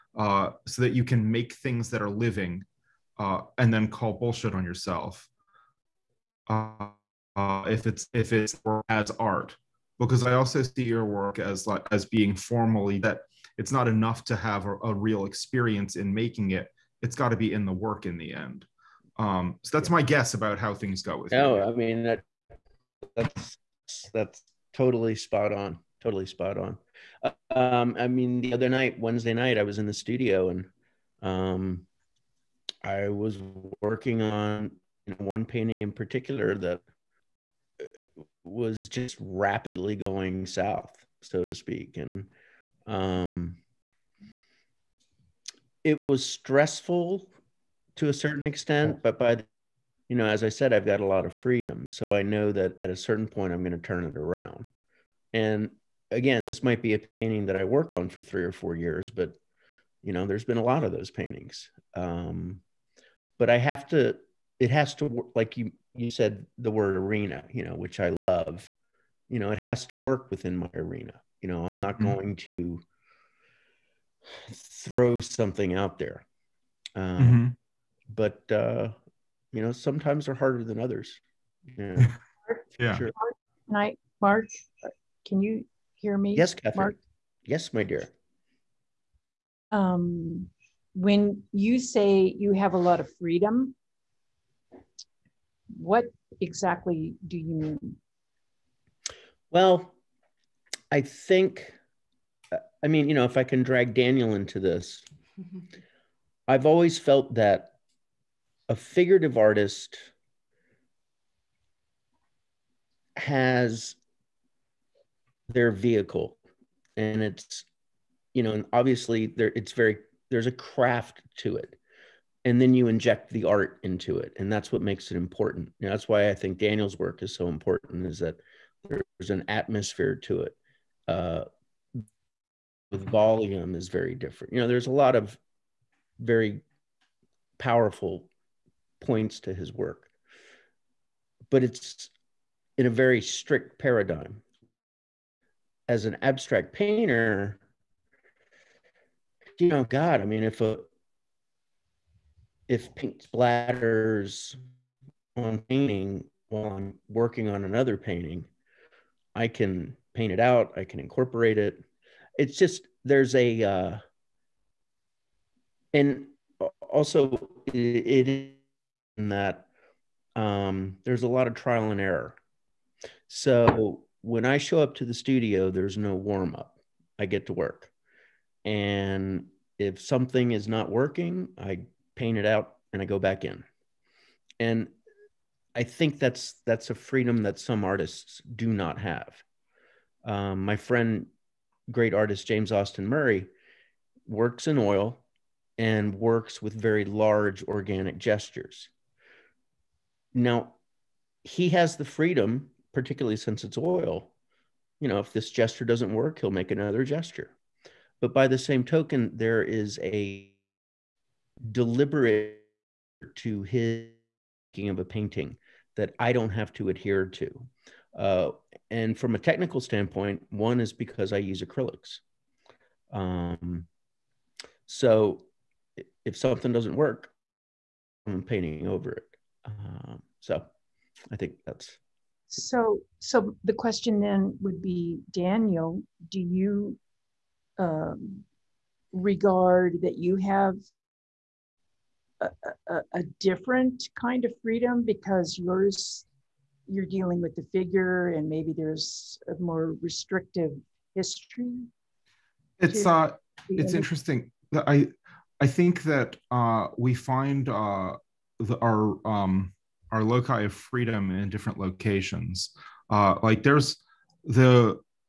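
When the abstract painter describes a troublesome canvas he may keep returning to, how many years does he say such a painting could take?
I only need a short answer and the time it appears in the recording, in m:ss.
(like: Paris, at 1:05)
3 or 4 years, at 0:58.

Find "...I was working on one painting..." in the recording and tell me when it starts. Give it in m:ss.
0:32.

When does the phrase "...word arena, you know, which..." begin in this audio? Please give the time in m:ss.
1:06.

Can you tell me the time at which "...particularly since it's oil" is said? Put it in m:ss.
3:22.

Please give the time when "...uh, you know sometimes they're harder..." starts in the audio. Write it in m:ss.
1:18.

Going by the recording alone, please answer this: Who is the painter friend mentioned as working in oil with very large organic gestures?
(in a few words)
James Austin Murray.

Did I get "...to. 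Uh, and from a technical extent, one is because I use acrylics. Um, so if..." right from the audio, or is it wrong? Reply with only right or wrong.
wrong.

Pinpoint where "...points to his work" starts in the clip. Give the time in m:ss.
2:18.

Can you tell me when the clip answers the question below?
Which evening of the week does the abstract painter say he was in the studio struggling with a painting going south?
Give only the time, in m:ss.
0:28.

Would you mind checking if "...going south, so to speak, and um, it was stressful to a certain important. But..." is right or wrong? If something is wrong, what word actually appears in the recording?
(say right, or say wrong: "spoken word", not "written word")
wrong: "extent", not "important".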